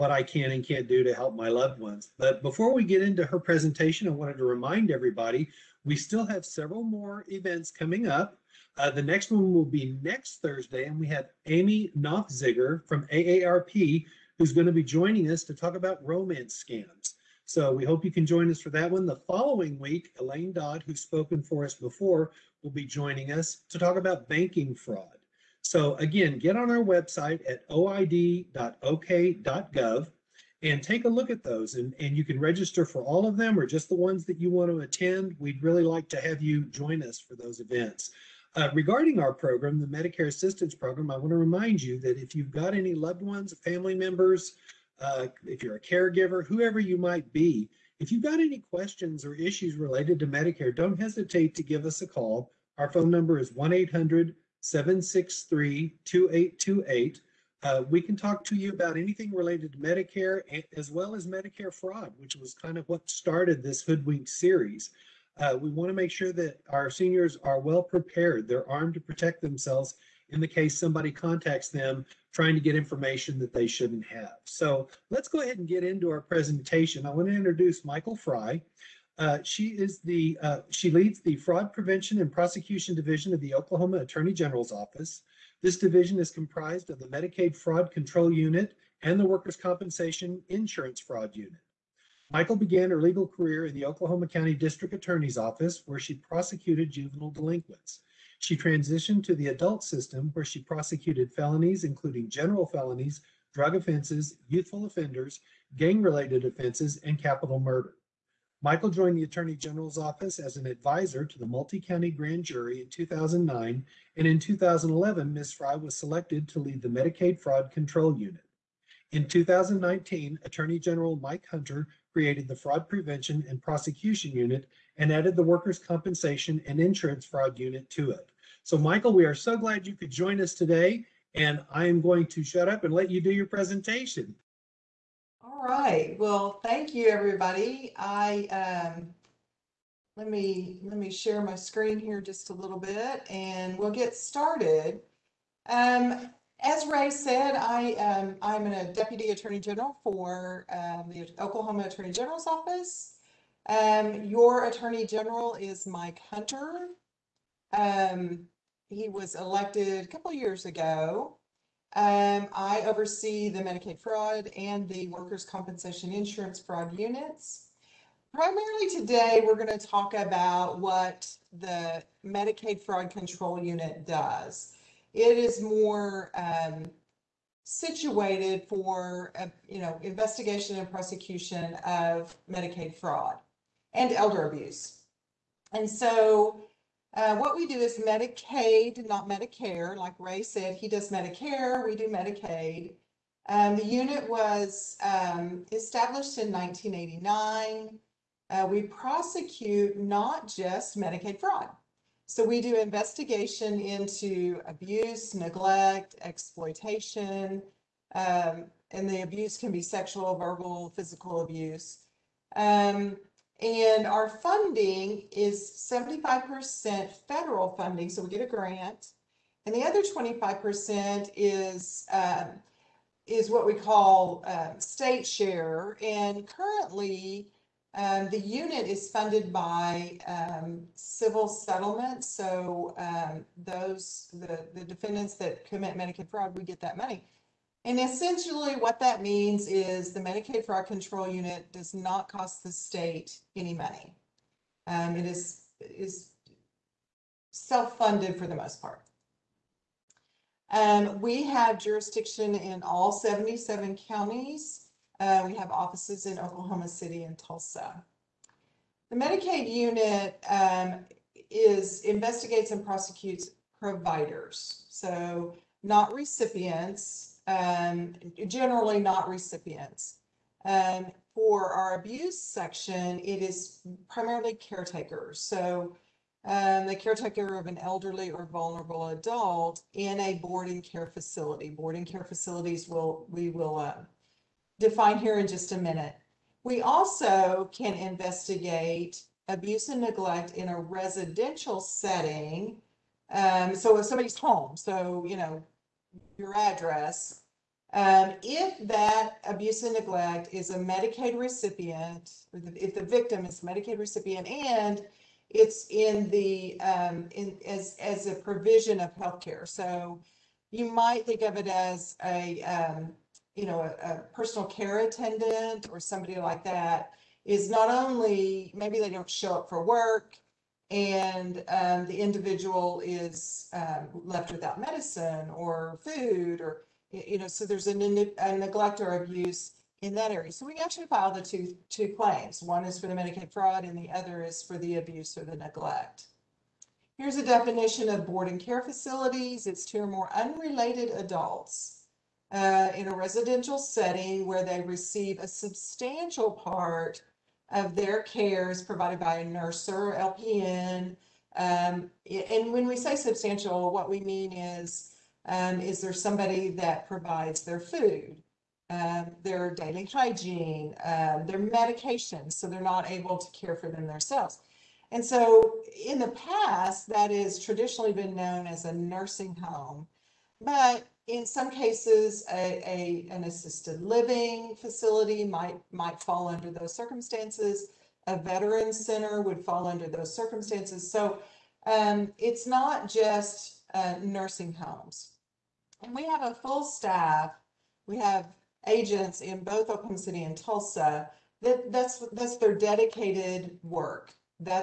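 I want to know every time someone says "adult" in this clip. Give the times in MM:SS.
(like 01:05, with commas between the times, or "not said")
01:39, 04:39, 05:41.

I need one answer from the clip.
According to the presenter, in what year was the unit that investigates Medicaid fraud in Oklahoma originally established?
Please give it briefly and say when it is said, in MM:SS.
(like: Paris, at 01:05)
1989, at 03:16.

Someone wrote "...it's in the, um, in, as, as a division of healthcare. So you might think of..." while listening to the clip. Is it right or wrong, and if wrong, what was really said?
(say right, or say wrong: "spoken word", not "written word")
wrong: "provision", not "division".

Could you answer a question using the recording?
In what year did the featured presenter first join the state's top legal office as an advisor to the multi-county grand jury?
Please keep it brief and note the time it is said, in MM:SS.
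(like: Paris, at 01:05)
2009, at 01:52.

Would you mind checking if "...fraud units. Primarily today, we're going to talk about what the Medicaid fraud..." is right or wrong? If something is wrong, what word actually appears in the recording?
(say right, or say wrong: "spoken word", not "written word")
right.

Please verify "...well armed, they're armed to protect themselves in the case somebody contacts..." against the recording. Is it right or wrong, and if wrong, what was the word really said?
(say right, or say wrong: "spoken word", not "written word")
wrong: "prepared", not "armed".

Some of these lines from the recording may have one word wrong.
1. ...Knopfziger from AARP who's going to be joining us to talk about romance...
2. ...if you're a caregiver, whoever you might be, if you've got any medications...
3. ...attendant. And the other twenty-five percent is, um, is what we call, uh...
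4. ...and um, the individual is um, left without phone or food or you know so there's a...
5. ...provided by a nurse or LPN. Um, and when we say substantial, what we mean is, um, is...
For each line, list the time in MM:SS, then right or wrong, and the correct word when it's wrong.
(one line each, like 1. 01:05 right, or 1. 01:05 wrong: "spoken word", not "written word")
1. 00:11 right
2. 00:45 wrong: "questions", not "medications"
3. 03:38 wrong: "grant", not "attendant"
4. 05:20 wrong: "medicine", not "phone"
5. 05:48 right.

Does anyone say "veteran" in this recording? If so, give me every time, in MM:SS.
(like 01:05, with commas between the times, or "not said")
06:18.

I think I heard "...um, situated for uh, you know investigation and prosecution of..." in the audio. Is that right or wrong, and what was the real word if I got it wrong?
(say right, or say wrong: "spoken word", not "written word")
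right.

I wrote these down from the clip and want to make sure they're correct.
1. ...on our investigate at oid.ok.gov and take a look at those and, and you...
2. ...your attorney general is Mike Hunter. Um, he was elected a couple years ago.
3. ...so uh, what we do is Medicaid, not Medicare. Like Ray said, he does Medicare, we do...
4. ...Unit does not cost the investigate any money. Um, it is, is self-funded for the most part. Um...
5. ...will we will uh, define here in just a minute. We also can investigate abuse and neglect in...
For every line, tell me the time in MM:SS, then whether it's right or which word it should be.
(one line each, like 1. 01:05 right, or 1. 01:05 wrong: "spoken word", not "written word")
1. 00:26 wrong: "website", not "investigate"
2. 02:34 right
3. 03:05 right
4. 04:01 wrong: "state", not "investigate"
5. 04:42 right.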